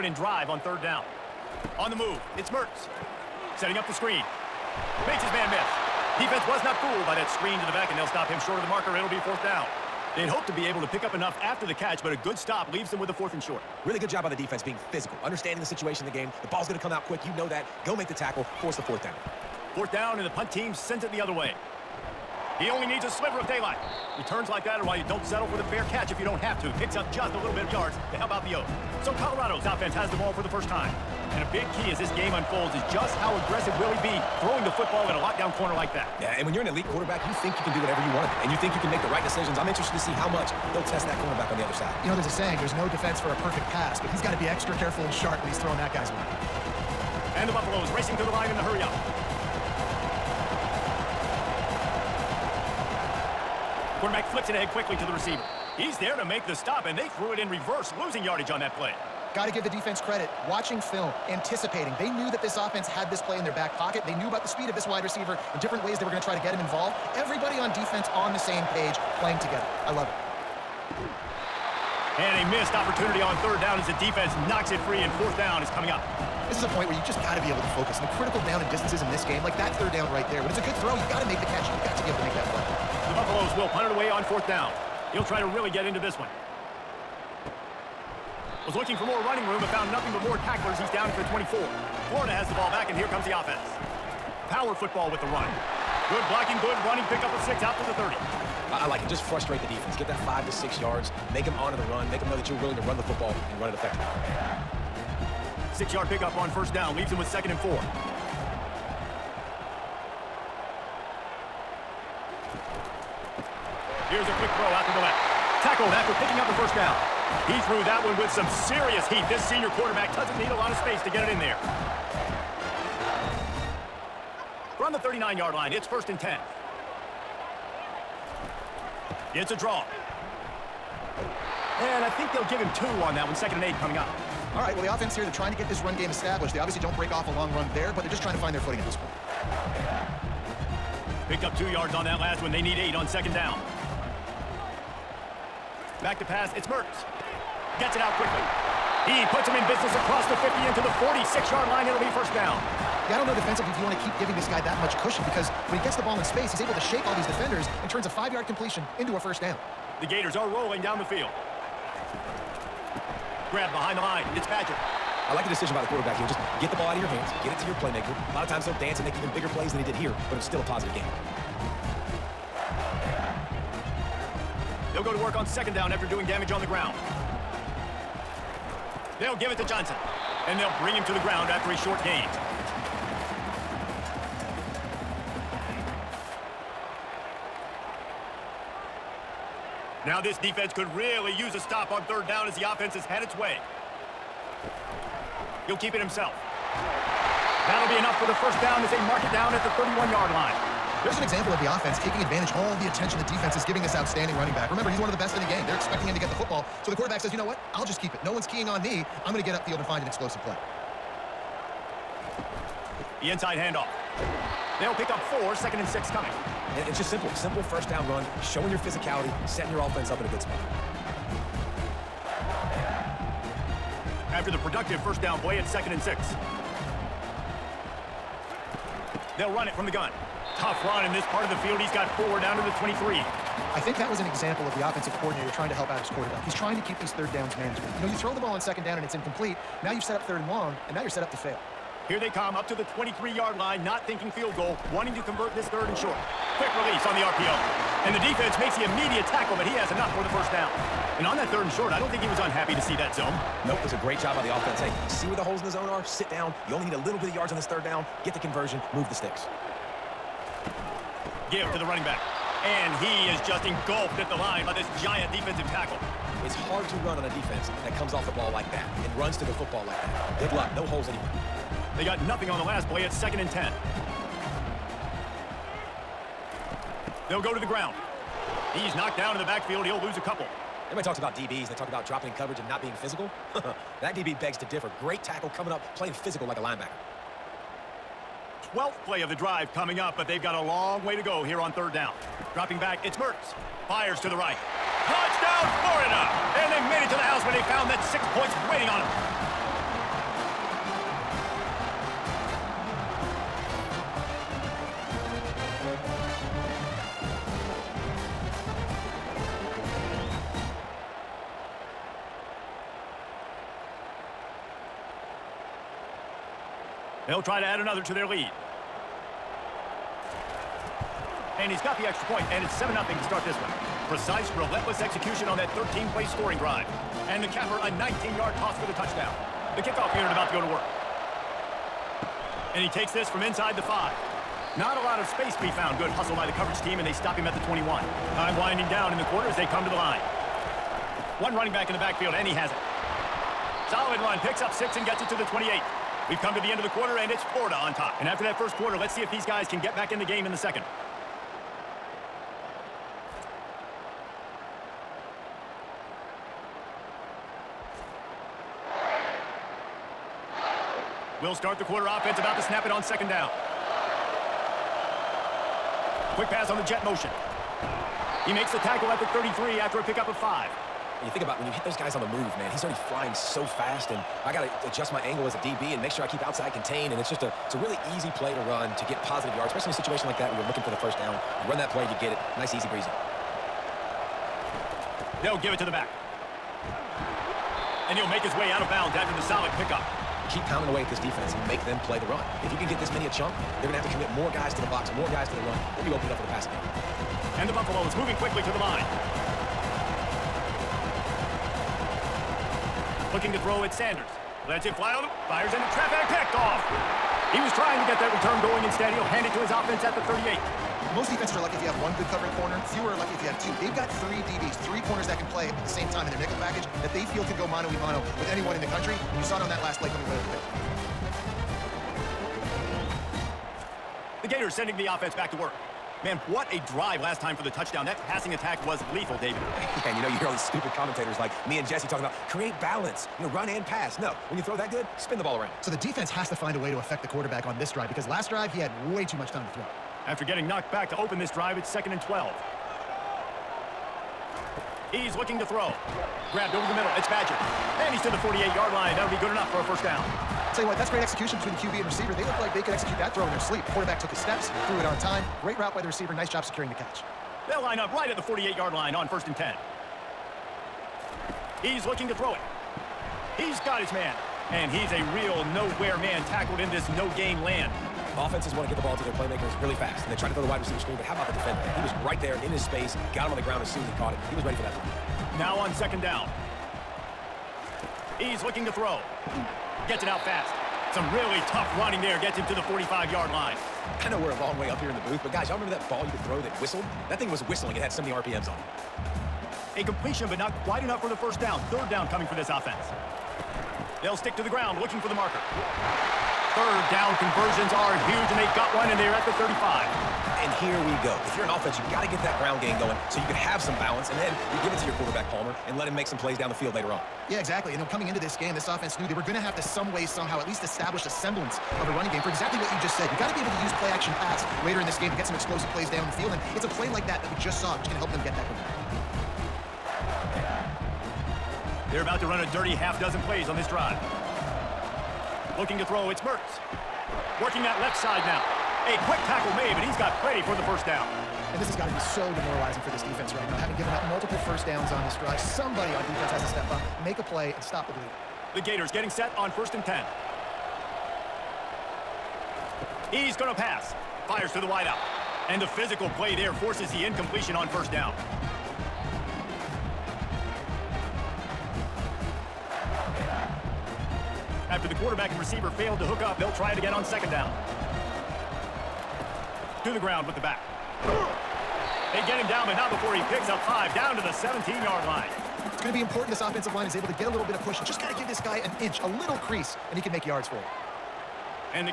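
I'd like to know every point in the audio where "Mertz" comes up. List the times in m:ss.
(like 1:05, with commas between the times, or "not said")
0:02, 2:26, 4:53, 8:46.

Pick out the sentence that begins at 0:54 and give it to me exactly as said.
Quarterback flips it ahead quickly to the receiver.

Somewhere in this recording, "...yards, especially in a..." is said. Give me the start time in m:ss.
6:19.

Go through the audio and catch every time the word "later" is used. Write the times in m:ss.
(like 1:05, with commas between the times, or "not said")
8:26, 8:34.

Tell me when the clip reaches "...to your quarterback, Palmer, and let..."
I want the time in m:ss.
8:24.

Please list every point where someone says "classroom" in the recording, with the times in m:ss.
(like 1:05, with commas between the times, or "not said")
not said.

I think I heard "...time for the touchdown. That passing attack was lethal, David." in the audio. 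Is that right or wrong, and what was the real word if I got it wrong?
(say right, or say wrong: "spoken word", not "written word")
right.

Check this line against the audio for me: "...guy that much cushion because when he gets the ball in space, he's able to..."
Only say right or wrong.
right.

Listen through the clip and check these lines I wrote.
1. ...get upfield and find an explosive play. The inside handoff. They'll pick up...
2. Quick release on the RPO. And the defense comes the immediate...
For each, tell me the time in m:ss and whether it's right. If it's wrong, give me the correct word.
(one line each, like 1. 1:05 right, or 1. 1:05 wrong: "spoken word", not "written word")
1. 3:29 right
2. 4:06 wrong: "makes", not "comes".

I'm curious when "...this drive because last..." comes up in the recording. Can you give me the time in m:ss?
7:17.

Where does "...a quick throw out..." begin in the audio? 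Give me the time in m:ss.
1:54.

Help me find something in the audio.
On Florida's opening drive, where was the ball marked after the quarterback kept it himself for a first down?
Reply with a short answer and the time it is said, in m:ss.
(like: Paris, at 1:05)
31-yard line, at 3:19.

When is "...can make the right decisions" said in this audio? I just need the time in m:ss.
0:38.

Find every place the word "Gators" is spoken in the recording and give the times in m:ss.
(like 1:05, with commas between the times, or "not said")
2:40, 7:04, 8:58.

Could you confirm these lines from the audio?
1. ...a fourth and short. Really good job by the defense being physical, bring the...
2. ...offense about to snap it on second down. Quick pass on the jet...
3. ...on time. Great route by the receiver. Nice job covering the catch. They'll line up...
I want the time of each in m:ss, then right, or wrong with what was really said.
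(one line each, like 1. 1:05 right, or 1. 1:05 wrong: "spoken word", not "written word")
1. 0:13 wrong: "understanding", not "bring"
2. 6:02 right
3. 7:35 wrong: "securing", not "covering".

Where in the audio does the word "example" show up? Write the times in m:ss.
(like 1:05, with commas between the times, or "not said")
3:21, 3:54.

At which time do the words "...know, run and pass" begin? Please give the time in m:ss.
7:13.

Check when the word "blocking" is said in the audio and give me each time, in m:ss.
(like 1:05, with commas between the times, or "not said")
1:36.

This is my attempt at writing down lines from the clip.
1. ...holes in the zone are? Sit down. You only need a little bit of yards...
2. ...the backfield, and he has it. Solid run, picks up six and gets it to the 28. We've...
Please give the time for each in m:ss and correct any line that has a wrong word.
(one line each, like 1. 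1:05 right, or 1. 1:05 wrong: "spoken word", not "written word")
1. 4:15 right
2. 5:41 right.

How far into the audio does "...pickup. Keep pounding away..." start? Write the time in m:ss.
6:29.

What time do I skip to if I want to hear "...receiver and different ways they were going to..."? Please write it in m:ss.
1:05.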